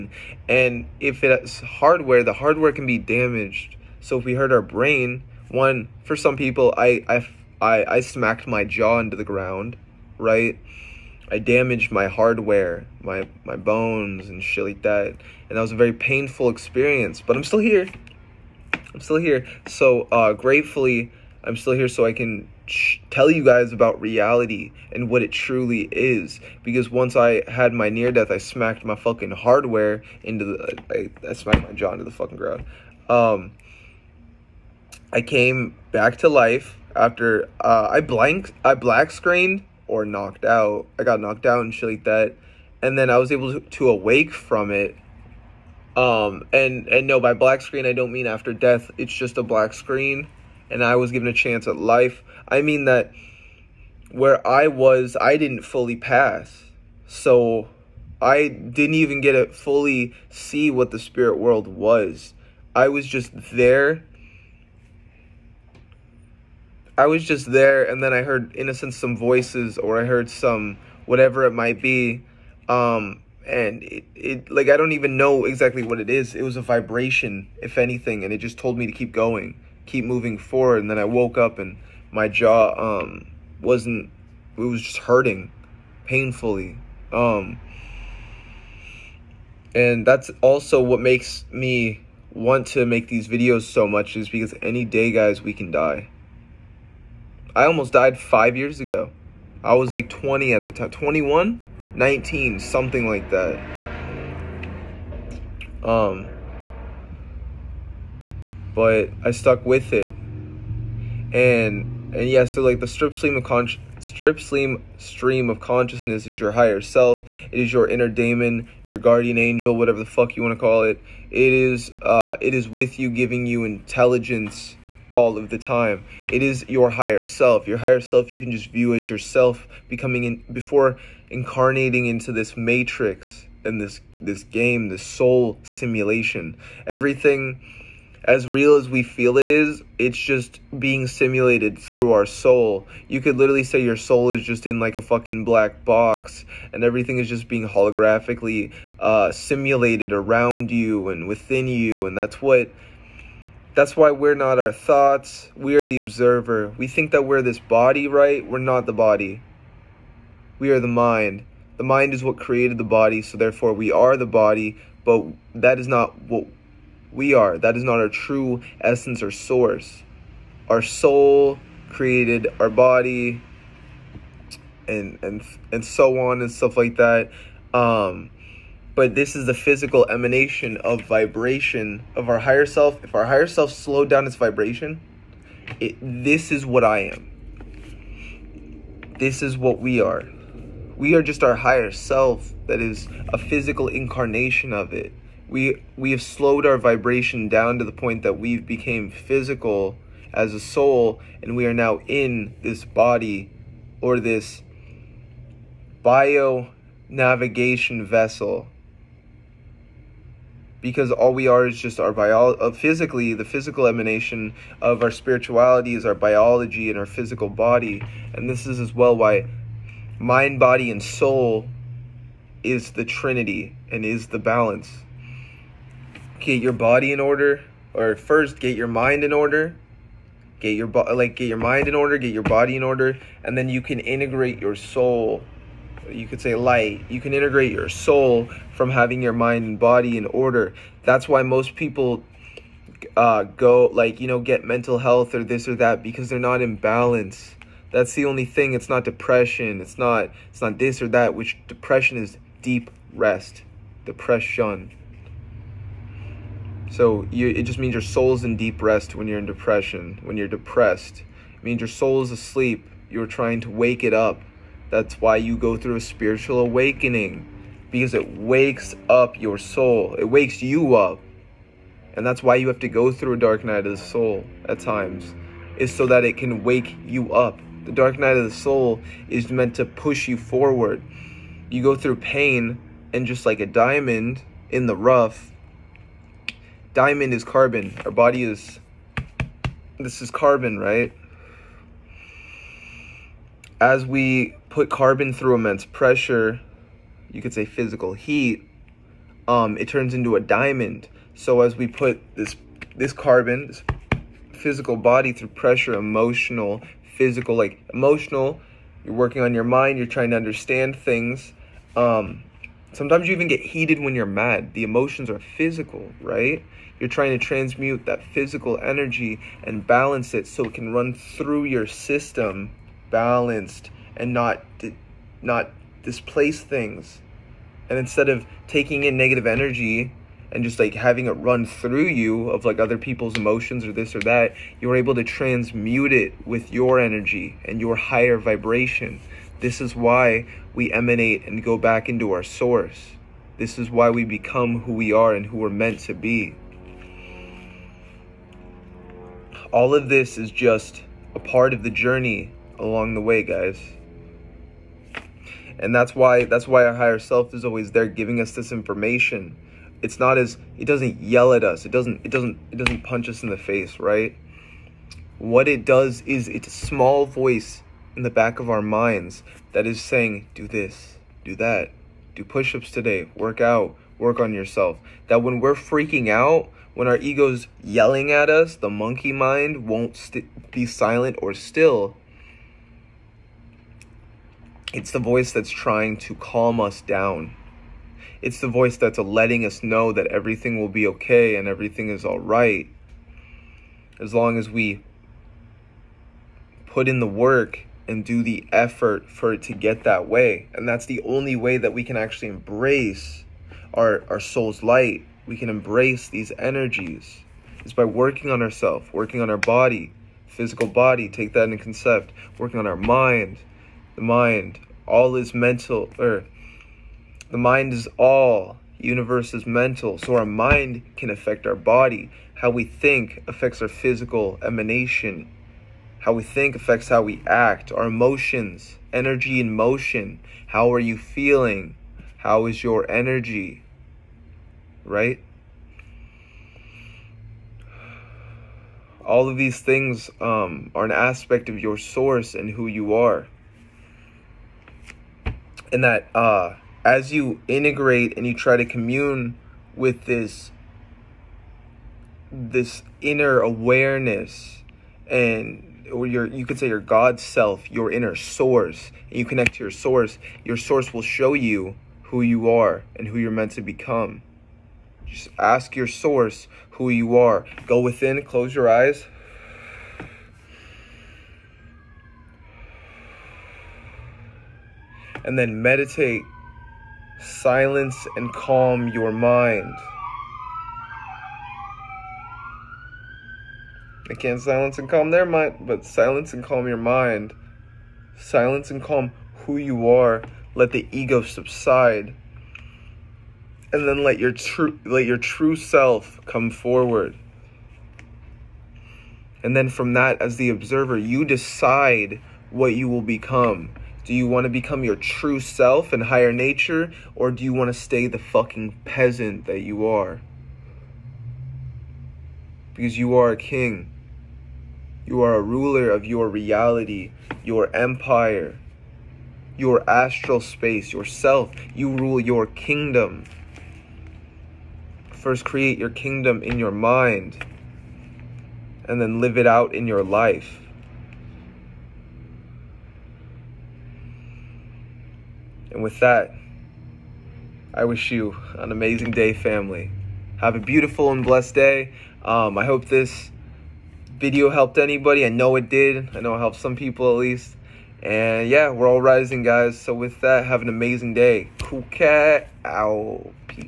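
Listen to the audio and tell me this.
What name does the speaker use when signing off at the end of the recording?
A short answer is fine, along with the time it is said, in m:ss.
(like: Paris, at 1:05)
Occult Cat, at 9:11.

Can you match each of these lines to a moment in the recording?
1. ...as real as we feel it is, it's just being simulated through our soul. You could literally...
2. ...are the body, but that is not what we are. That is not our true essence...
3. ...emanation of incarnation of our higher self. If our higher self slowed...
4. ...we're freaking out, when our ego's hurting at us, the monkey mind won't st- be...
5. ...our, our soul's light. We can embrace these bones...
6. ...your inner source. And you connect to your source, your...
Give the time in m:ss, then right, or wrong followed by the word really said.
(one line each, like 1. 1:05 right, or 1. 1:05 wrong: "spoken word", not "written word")
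1. 2:18 right
2. 2:43 right
3. 3:00 wrong: "vibration", not "incarnation"
4. 6:15 wrong: "yelling", not "hurting"
5. 6:43 wrong: "energies", not "bones"
6. 7:37 right.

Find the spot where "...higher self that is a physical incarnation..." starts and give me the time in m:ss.
3:11.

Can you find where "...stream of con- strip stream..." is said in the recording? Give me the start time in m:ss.
1:53.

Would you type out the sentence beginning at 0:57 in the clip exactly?
So I didn't even get to fully see what the spirit world was.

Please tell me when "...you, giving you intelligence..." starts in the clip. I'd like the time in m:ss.
2:02.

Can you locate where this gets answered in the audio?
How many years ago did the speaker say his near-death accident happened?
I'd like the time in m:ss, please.
1:38.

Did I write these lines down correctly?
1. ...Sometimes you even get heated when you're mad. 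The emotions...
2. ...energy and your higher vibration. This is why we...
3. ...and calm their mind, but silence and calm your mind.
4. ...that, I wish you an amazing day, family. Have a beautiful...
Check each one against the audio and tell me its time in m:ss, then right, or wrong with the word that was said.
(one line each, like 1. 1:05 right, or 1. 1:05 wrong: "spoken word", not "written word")
1. 5:12 right
2. 5:36 right
3. 8:04 right
4. 8:56 right.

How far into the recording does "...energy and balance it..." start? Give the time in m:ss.
5:18.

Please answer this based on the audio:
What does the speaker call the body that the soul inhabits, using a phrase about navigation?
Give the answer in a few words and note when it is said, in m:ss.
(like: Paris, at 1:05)
Bio navigation vessel, at 3:26.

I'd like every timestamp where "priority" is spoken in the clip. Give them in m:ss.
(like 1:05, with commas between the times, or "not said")
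not said.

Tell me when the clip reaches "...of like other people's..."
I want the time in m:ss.
5:32.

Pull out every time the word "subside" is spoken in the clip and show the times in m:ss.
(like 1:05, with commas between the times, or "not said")
8:11.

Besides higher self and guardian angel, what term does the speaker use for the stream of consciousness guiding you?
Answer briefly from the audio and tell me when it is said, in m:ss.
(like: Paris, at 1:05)
Inner daemon, at 1:57.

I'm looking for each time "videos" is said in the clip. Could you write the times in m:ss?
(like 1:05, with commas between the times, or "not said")
1:33, 9:04.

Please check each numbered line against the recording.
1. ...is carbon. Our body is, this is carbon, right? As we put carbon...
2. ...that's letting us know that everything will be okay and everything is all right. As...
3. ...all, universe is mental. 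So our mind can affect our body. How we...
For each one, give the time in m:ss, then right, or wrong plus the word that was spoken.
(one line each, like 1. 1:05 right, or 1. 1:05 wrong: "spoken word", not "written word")
1. 4:47 right
2. 6:28 right
3. 6:58 right.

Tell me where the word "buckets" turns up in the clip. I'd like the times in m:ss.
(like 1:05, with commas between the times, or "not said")
not said.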